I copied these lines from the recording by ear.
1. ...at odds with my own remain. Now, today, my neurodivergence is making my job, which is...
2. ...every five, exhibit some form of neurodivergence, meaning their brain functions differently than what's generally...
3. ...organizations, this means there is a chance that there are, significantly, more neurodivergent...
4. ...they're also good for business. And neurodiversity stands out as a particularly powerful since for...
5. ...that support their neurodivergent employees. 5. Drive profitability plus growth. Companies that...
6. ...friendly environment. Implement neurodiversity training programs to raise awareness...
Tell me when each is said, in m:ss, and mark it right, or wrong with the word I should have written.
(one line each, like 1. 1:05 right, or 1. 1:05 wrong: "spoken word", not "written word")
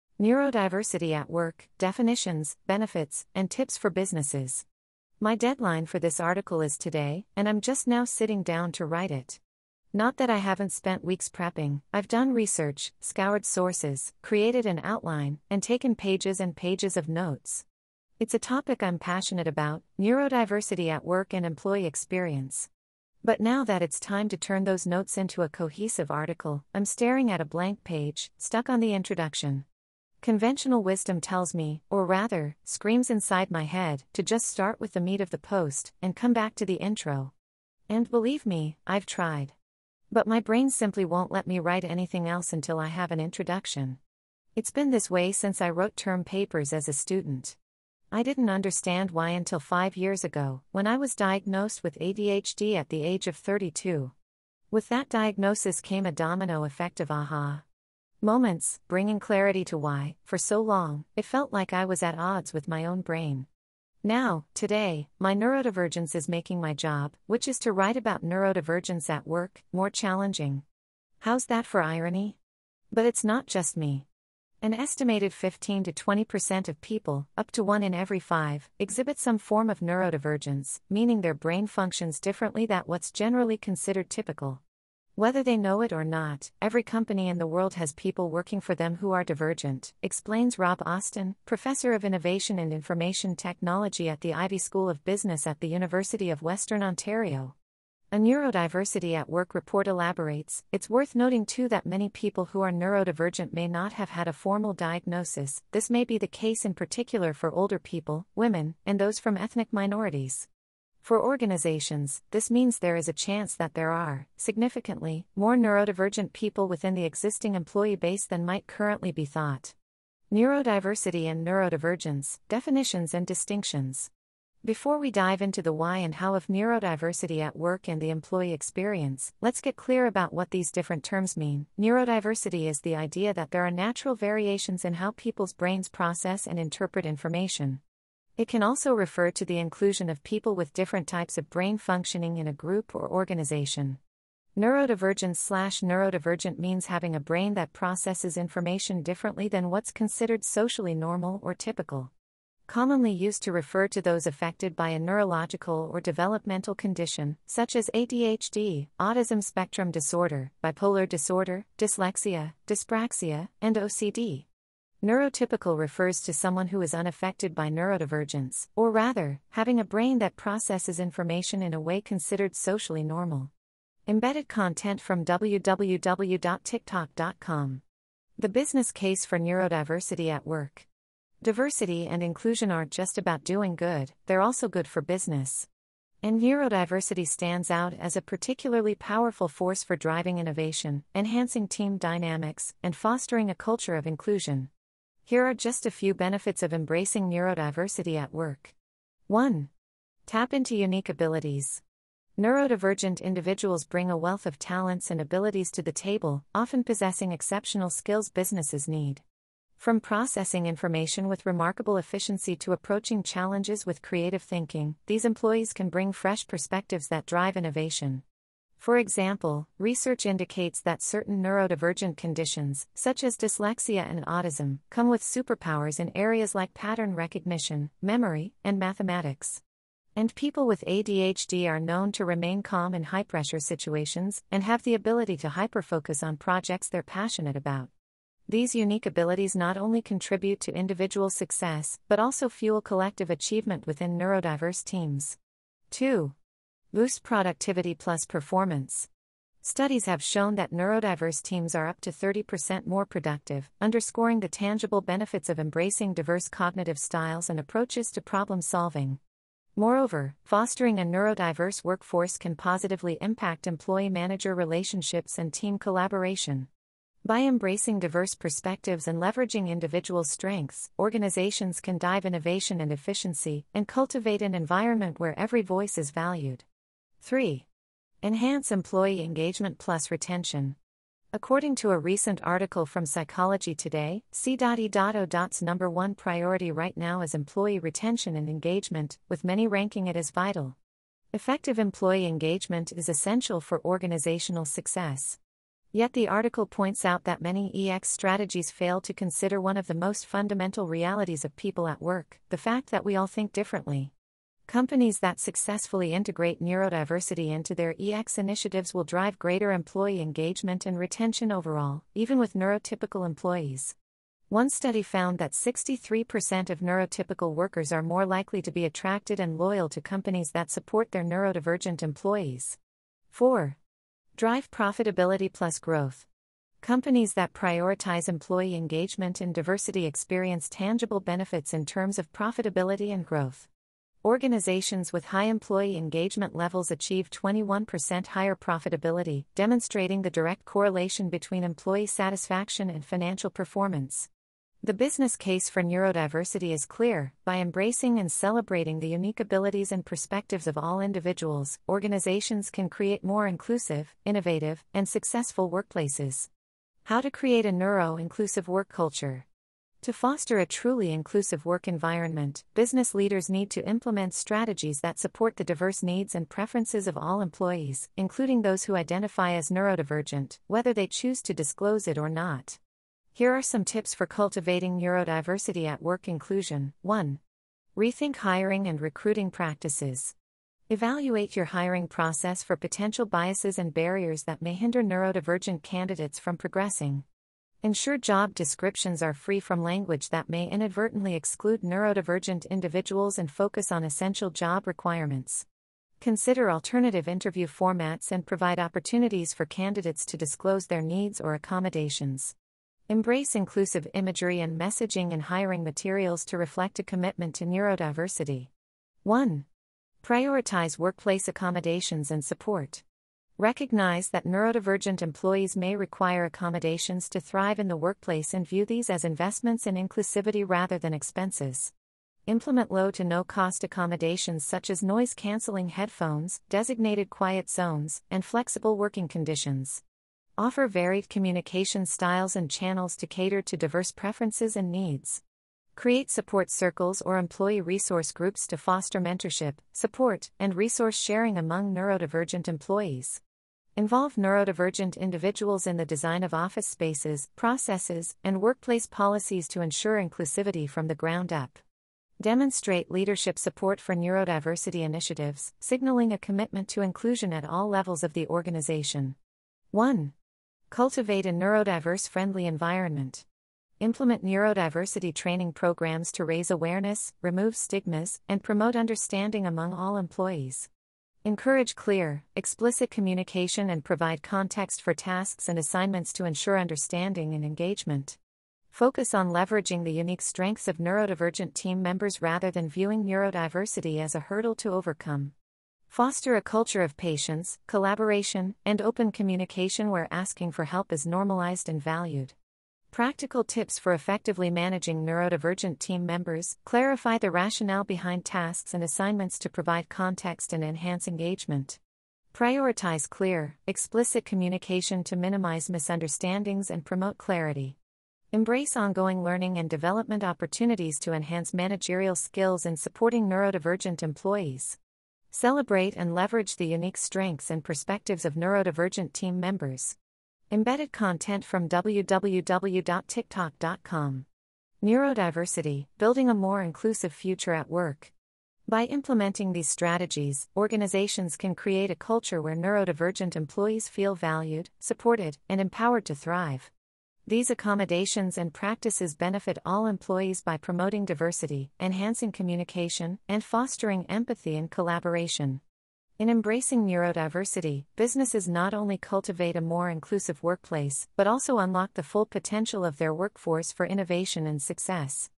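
1. 1:02 wrong: "brain", not "remain"
2. 1:17 right
3. 1:51 right
4. 3:04 wrong: "force", not "since"
5. 5:20 wrong: "4", not "5"
6. 7:42 right.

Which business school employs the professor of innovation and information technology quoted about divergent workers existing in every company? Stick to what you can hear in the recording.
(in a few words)
Ivey School of Business.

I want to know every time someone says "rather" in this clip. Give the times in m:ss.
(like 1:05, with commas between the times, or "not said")
0:32, 2:48, 7:00, 8:02.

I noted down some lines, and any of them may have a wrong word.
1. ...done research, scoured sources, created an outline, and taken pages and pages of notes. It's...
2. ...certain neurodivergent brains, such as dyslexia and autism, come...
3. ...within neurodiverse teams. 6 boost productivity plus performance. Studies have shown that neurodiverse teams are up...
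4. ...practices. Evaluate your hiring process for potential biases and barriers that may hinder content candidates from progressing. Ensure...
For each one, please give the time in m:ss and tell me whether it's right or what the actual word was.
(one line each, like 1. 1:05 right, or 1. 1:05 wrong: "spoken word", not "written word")
1. 0:12 right
2. 3:41 wrong: "conditions", not "brains"
3. 4:03 wrong: "2", not "6"
4. 6:19 wrong: "neurodivergent", not "content".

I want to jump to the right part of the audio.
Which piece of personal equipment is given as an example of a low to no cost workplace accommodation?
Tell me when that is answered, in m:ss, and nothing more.
7:05.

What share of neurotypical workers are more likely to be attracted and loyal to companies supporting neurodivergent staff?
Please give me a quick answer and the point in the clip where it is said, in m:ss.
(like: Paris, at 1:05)
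63%, at 5:15.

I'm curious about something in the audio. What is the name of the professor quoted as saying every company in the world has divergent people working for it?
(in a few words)
Rob Austin.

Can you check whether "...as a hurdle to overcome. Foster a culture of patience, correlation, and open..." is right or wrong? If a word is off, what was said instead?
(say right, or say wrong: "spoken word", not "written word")
wrong: "collaboration", not "correlation".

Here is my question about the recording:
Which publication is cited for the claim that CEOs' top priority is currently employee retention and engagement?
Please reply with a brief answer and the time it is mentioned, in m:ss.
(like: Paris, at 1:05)
Psychology Today, at 4:43.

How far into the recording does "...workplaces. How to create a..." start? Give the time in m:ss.
5:55.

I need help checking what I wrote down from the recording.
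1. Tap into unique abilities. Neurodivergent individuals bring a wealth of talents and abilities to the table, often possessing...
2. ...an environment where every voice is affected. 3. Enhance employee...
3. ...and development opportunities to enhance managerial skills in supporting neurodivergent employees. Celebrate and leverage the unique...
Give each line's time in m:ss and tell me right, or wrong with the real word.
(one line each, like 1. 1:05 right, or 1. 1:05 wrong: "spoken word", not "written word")
1. 3:20 right
2. 4:34 wrong: "valued", not "affected"
3. 8:29 right.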